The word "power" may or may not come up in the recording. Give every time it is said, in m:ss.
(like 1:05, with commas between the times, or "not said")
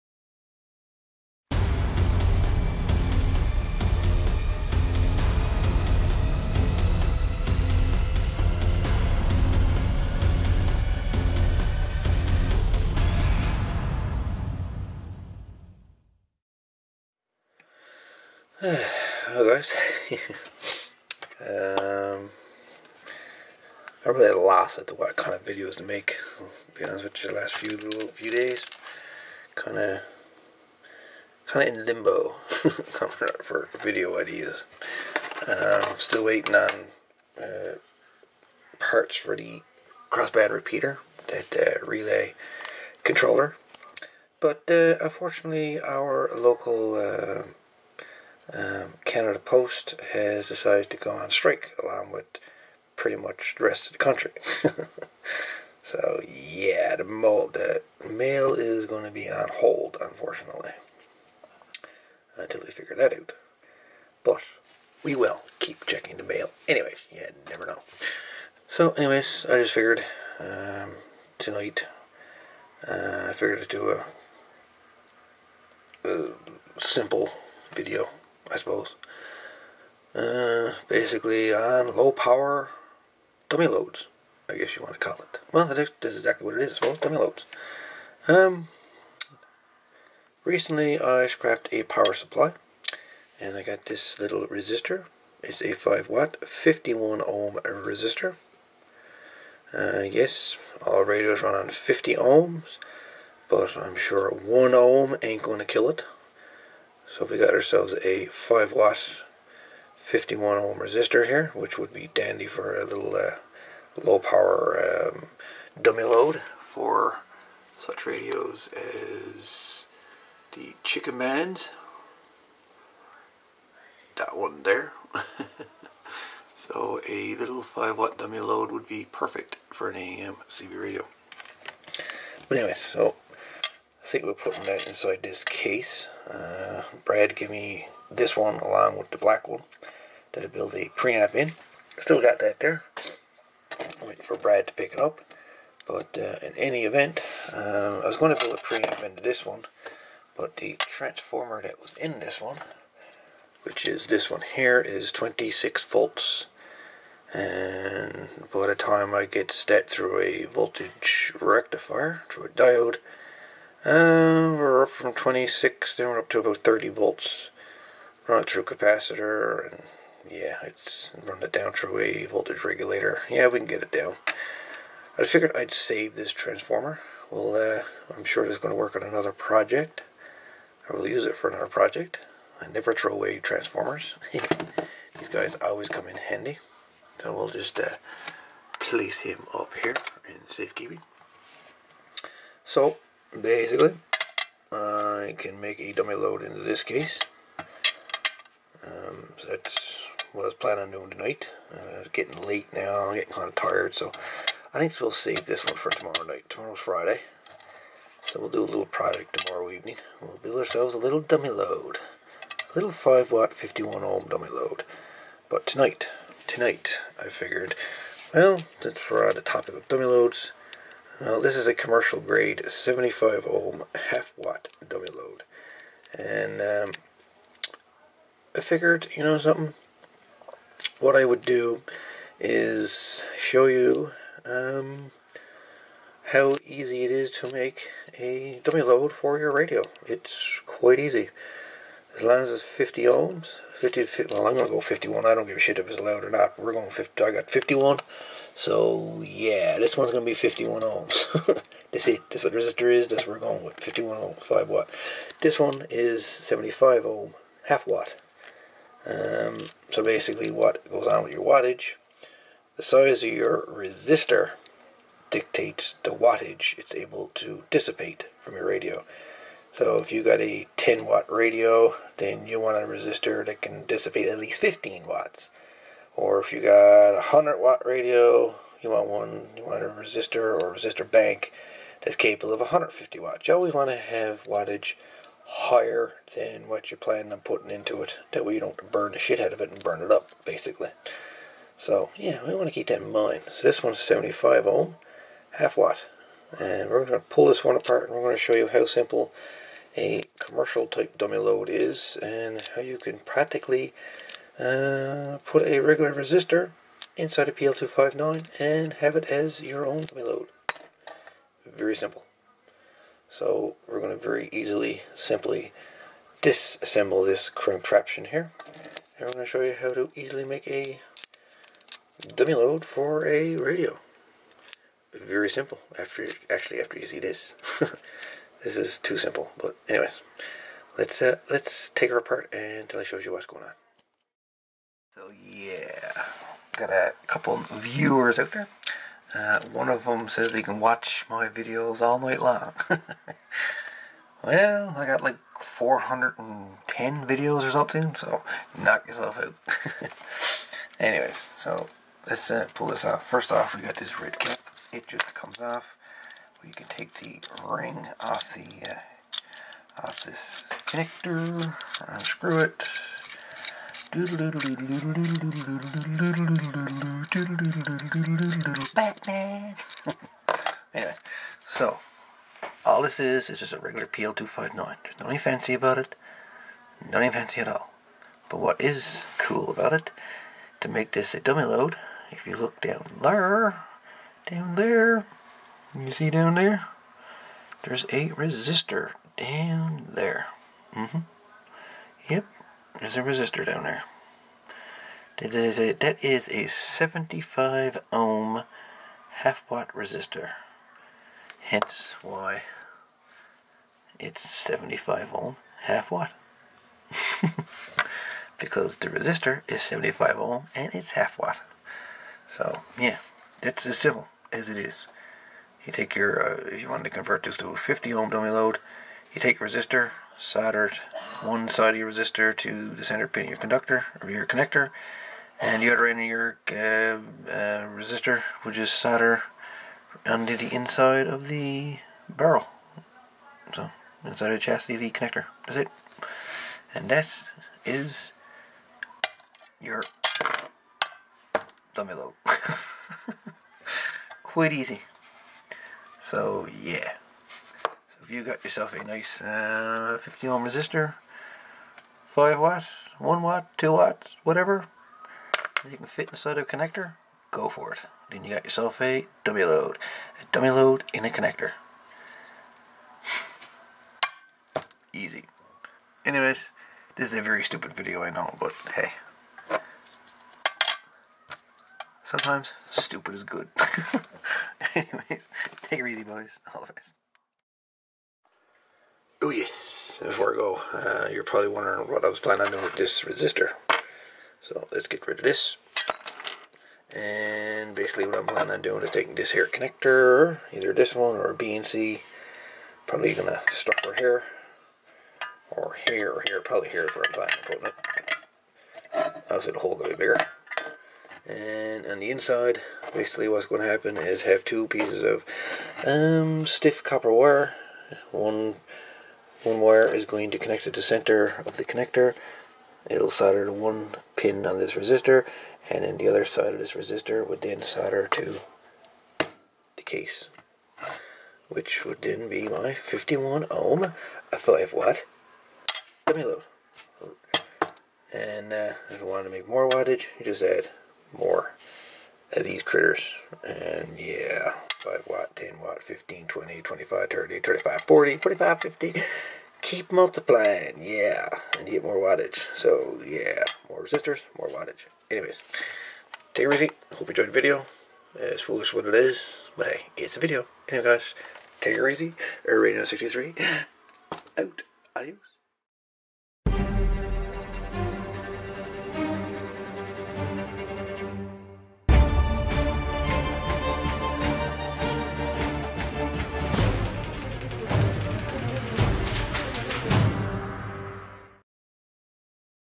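1:22, 1:31, 1:54.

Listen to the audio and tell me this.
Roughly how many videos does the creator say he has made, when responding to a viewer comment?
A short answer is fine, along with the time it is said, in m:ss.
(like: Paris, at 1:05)
410, at 5:45.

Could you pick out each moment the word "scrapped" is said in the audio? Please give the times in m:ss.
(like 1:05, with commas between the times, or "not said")
1:31.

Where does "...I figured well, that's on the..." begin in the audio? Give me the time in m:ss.
3:37.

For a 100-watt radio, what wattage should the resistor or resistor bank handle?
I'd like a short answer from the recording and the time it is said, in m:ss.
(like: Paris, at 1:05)
150 watts, at 4:42.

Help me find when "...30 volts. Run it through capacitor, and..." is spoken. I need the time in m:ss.
2:46.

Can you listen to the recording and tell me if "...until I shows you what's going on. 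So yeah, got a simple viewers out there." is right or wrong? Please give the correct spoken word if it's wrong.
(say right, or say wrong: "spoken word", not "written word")
wrong: "couple", not "simple".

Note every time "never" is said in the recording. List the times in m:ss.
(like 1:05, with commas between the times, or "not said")
1:07, 3:02.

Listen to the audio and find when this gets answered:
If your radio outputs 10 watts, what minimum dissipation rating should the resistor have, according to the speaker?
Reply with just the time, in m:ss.
4:34.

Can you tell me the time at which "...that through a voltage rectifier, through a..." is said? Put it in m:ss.
2:39.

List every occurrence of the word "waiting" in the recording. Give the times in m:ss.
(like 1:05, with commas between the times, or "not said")
0:36, 2:24.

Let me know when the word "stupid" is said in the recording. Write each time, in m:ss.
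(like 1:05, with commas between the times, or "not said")
7:47, 7:52.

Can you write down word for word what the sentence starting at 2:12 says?
But anyway, so think we're putting that inside this case.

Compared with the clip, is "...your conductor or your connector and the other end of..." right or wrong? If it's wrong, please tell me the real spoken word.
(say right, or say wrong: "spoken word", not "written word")
right.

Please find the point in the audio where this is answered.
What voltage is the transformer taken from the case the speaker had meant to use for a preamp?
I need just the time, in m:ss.
2:35.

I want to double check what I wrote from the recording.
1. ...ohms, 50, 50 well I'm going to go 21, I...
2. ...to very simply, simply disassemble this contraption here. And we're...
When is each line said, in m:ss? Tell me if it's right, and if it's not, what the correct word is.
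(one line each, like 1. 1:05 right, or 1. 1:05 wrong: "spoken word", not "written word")
1. 4:03 wrong: "51", not "21"
2. 5:14 wrong: "easily", not "simply".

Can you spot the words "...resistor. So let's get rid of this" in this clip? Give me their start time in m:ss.
8:03.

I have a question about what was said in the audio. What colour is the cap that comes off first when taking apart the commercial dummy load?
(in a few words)
Red.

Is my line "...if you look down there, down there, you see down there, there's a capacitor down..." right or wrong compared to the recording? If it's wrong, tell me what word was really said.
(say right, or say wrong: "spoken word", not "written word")
wrong: "resistor", not "capacitor".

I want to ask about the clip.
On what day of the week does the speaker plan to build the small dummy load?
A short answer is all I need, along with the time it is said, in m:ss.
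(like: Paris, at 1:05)
Friday, at 3:26.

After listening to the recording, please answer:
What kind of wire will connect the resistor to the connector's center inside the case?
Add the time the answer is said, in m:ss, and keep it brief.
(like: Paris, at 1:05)
Stiff copper wire, at 8:26.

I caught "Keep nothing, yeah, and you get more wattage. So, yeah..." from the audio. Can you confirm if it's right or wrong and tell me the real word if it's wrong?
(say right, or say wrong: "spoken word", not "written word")
wrong: "multiplying", not "nothing".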